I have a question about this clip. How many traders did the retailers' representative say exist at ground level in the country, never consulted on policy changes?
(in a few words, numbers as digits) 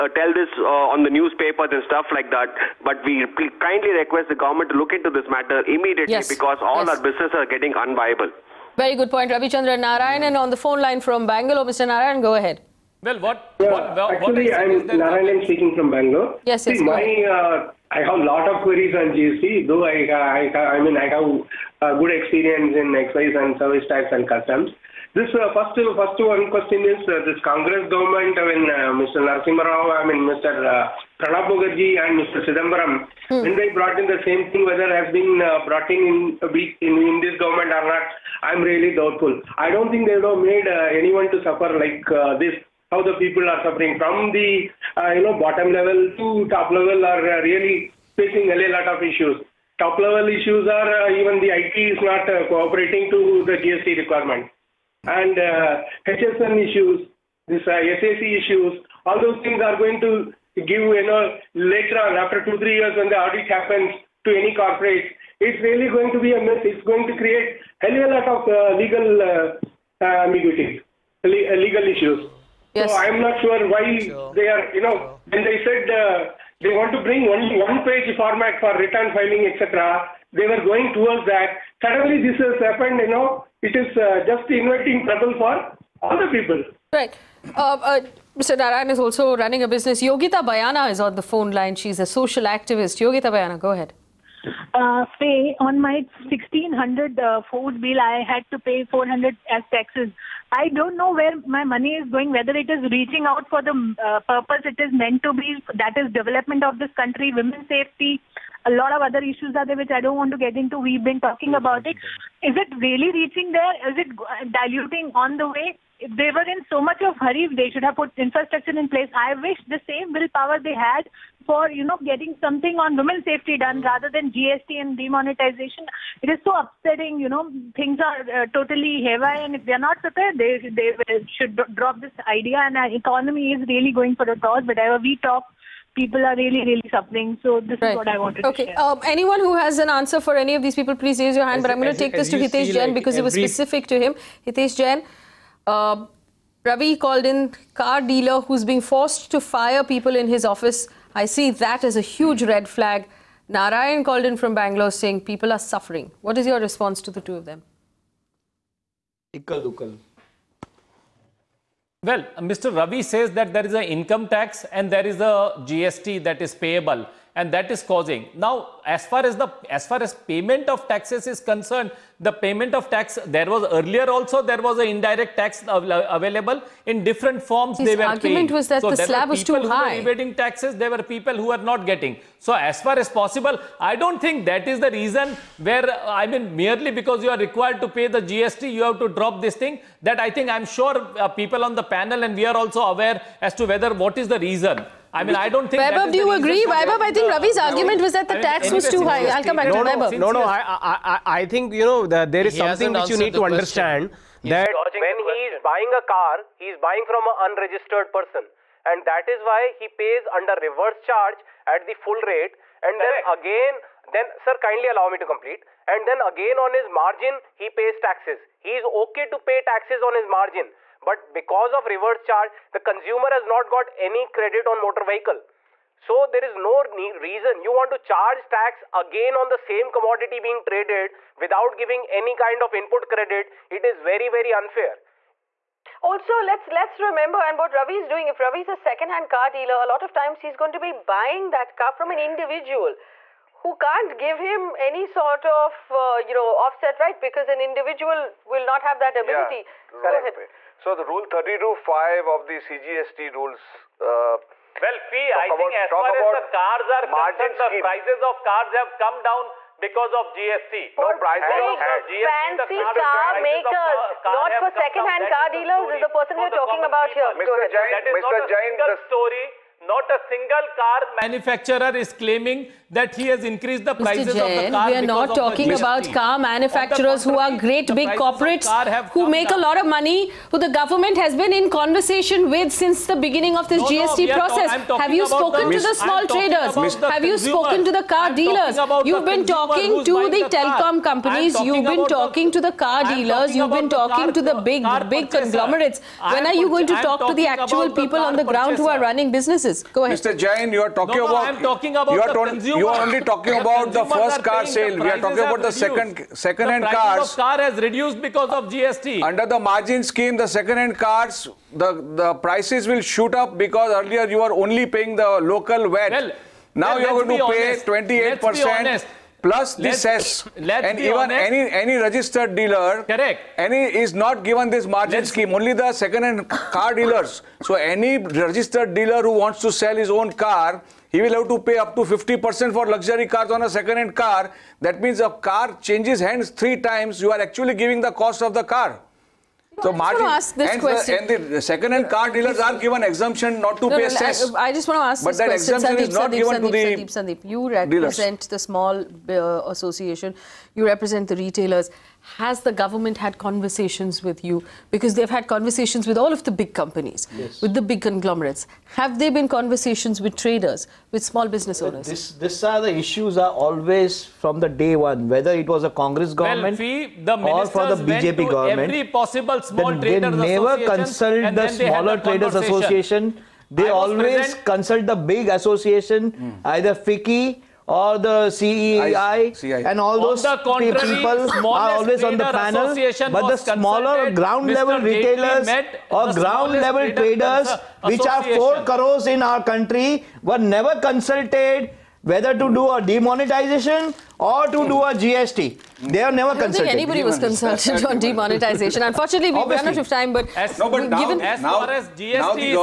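4 crores.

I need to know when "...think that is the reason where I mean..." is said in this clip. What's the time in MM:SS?
03:04.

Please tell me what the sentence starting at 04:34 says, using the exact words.
We are not talking about car manufacturers who are great big corporates who make down.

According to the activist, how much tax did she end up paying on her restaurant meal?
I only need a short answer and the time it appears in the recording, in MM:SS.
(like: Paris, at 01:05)
400, at 01:38.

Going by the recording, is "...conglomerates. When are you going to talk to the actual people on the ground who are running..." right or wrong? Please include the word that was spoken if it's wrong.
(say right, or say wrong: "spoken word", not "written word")
right.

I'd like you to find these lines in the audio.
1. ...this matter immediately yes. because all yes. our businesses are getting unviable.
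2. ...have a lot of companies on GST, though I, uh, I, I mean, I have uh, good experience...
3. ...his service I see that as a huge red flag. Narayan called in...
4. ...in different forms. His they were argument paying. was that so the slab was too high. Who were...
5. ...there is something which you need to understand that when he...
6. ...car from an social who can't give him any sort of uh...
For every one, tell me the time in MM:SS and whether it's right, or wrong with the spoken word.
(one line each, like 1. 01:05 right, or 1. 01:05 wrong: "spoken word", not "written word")
1. 00:05 right
2. 00:18 wrong: "queries", not "companies"
3. 02:30 wrong: "office", not "service"
4. 02:56 right
5. 03:22 right
6. 04:01 wrong: "individual", not "social".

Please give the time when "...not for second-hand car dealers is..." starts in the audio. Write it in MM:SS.
04:24.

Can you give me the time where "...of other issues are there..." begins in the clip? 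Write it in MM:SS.
01:48.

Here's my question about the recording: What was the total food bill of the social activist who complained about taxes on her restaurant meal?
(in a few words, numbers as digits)
1600.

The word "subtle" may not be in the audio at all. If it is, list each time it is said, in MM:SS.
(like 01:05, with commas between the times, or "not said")
not said.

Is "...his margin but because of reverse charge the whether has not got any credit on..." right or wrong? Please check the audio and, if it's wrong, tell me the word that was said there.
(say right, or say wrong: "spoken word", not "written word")
wrong: "consumer", not "whether".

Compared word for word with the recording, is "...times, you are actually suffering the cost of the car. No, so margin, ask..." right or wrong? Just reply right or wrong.
wrong.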